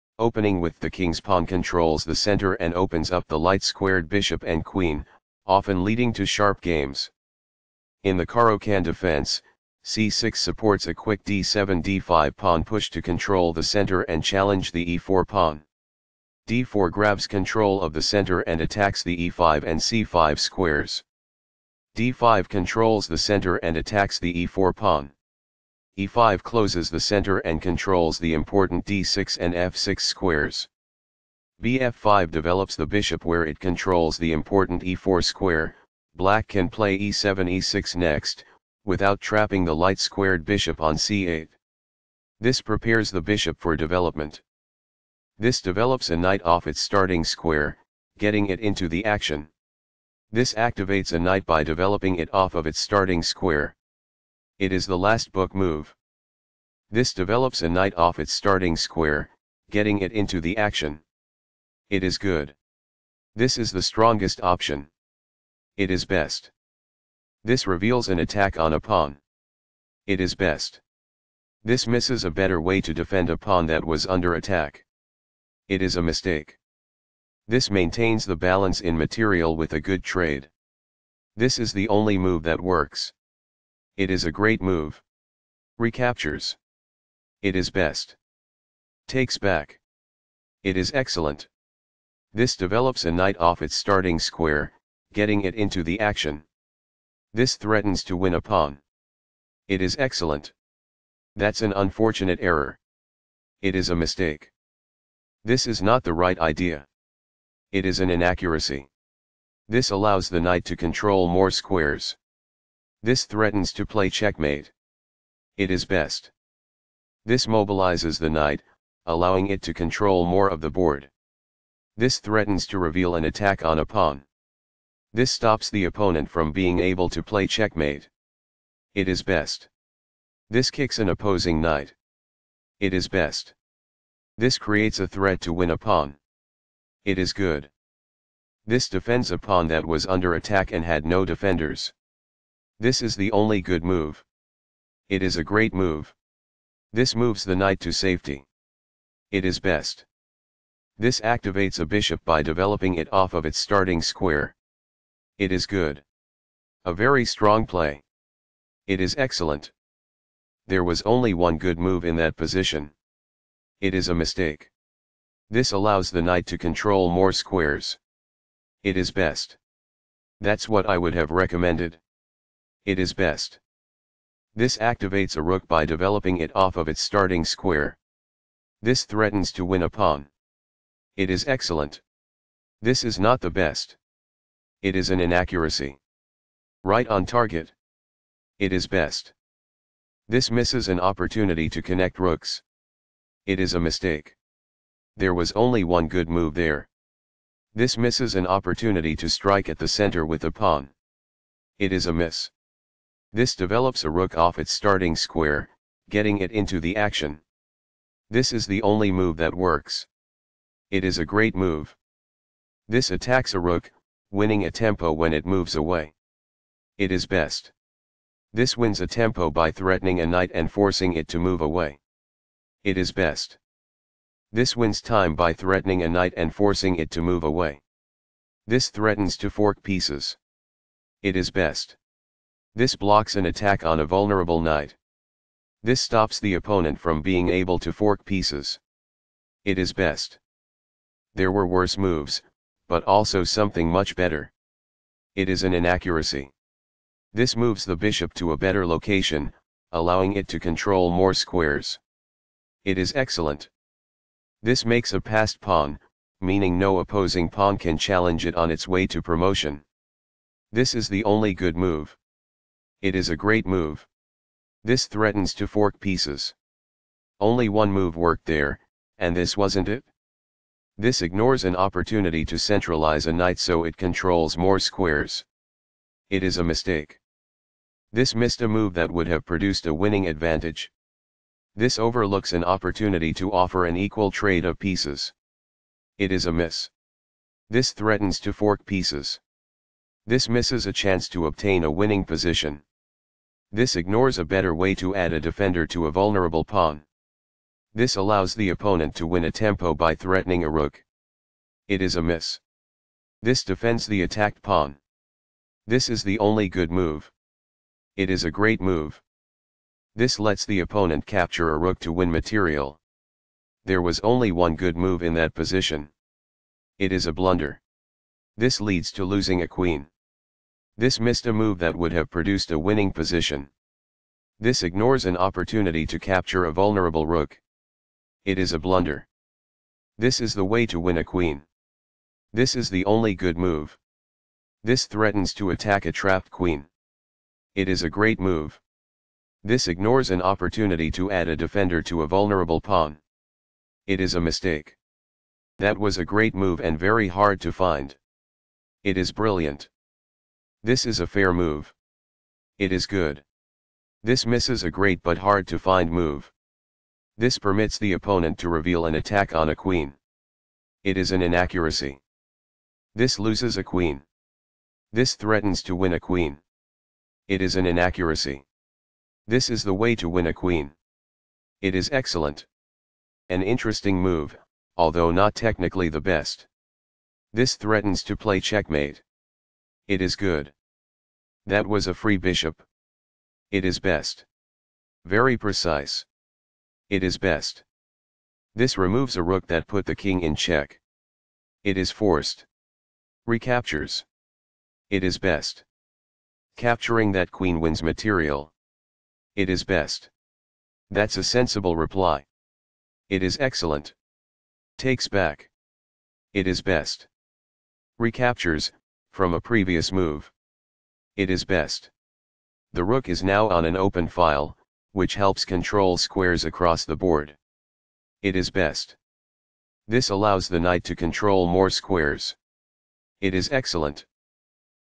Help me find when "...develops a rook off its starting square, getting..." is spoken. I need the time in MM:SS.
03:23.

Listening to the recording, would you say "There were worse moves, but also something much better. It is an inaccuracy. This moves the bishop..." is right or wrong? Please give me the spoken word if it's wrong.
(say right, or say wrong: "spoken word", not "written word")
right.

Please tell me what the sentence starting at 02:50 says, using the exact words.
That's what I would have recommended it is best.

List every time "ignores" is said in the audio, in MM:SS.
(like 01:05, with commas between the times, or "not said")
04:31, 04:53, 05:24, 05:39.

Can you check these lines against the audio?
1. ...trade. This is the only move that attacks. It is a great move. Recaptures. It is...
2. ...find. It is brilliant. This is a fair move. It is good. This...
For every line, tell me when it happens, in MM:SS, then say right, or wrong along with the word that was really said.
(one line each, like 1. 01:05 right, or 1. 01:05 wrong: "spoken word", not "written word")
1. 01:20 wrong: "works", not "attacks"
2. 05:47 right.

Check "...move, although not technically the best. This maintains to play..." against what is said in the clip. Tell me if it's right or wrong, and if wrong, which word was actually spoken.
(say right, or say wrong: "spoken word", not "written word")
wrong: "threatens", not "maintains".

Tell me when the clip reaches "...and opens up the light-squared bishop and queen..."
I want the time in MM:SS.
00:02.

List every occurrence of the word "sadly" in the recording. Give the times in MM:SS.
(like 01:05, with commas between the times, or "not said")
not said.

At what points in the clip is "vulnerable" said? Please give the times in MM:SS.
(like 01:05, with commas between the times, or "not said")
03:54, 04:56, 05:26, 05:42.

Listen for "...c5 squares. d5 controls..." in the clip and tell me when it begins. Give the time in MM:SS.
00:19.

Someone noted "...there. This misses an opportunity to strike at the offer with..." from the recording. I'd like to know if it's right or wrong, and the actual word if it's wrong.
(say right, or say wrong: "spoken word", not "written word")
wrong: "center", not "offer".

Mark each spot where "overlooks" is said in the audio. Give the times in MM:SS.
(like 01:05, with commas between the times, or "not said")
04:41.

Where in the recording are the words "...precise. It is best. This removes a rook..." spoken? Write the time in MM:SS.
06:25.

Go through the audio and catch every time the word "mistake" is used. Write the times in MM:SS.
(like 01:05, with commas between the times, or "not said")
01:16, 01:43, 02:44, 03:13, 04:36, 05:44.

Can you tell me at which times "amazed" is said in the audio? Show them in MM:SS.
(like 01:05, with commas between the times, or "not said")
not said.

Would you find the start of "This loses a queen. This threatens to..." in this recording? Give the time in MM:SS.
06:03.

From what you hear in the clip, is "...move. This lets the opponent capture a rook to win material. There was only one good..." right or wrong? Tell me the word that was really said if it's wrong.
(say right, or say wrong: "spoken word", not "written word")
right.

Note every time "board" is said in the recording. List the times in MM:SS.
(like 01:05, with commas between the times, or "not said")
02:00, 06:57.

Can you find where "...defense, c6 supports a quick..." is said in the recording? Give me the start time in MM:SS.
00:08.